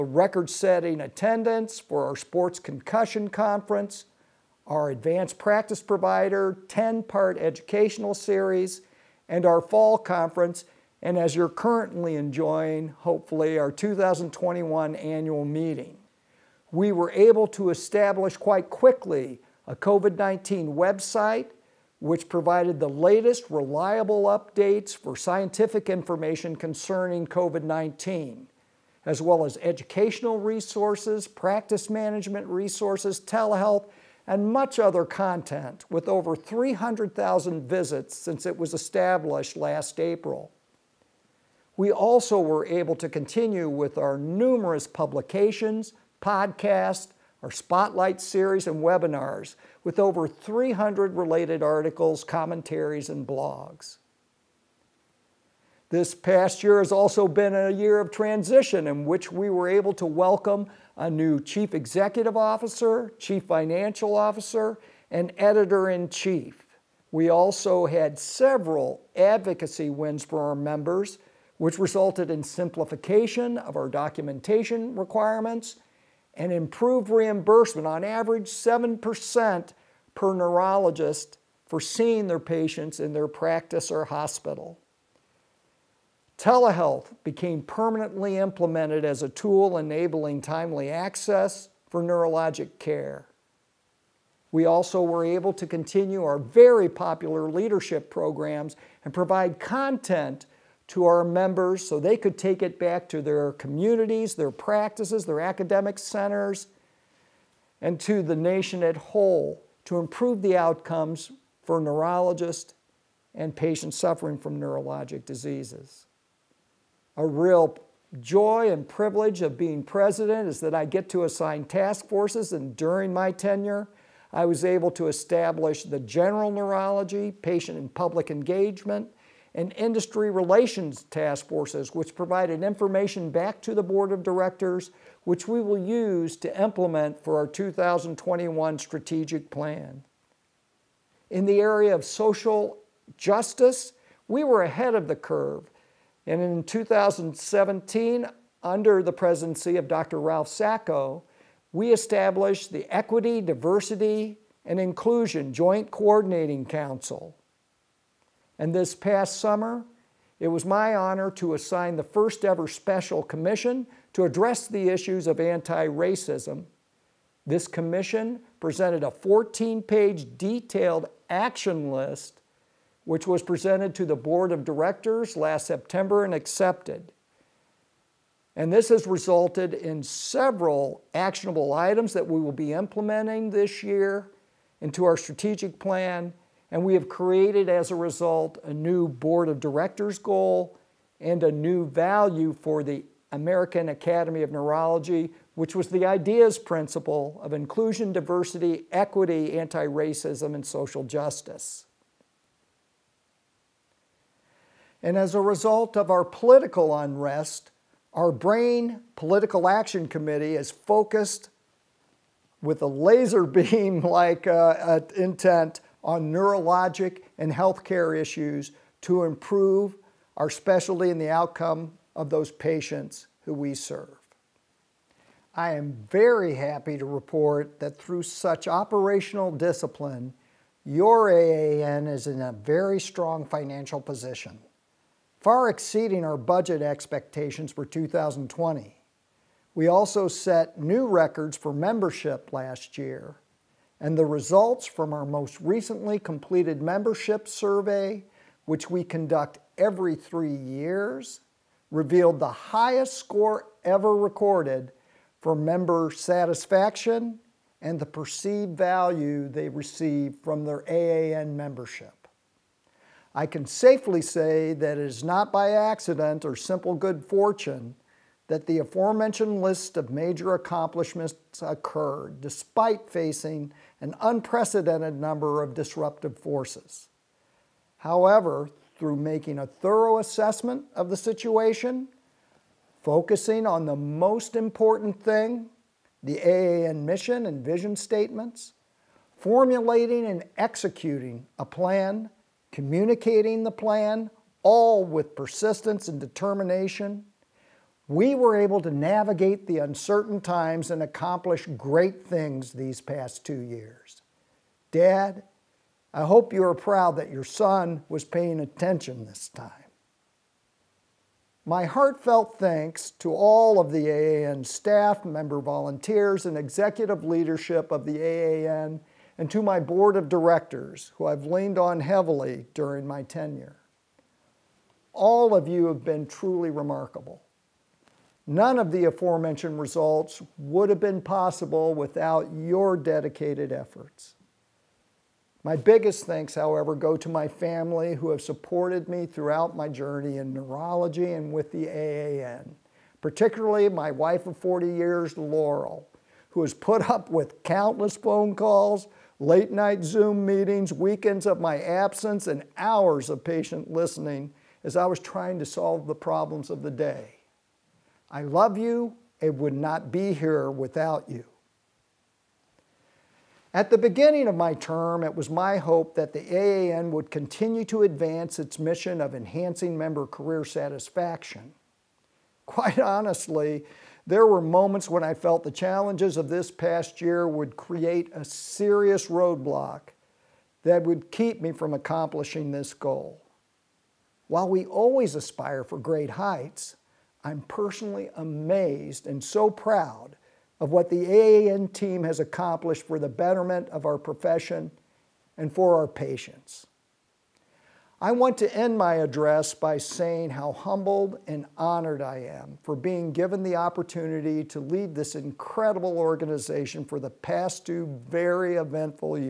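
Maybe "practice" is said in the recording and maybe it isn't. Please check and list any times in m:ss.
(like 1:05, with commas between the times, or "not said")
0:05, 0:31, 1:23, 1:44.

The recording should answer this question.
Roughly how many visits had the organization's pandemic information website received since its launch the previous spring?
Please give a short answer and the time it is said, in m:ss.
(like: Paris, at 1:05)
300,000, at 0:36.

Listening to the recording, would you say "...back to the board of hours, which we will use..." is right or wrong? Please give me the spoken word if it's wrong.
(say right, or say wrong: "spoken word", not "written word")
wrong: "directors", not "hours".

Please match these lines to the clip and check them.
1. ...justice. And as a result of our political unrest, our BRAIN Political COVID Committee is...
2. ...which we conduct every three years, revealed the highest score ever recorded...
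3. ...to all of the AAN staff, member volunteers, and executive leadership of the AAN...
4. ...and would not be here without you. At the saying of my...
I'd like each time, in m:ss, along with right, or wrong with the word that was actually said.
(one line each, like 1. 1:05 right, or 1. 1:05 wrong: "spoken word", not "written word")
1. 3:21 wrong: "Action", not "COVID"
2. 4:08 right
3. 5:13 right
4. 5:59 wrong: "beginning", not "saying".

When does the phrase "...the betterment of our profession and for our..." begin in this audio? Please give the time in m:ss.
6:33.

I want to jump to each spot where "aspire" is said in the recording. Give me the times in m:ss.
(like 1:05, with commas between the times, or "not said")
6:25.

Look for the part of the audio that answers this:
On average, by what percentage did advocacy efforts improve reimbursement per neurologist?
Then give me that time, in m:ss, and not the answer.
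1:18.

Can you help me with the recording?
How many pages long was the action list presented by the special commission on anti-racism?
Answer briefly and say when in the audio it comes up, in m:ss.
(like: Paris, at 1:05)
14, at 2:49.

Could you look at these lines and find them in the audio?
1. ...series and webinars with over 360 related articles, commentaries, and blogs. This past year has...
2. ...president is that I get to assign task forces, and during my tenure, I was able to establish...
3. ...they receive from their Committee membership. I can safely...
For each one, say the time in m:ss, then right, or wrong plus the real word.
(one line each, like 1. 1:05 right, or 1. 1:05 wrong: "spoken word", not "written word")
1. 0:48 wrong: "300", not "360"
2. 1:59 right
3. 4:19 wrong: "AAN", not "Committee".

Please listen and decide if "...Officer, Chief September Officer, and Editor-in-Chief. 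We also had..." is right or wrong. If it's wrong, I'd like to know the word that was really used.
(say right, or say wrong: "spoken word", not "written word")
wrong: "Financial", not "September".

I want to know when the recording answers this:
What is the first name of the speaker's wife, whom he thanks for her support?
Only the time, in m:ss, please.
5:45.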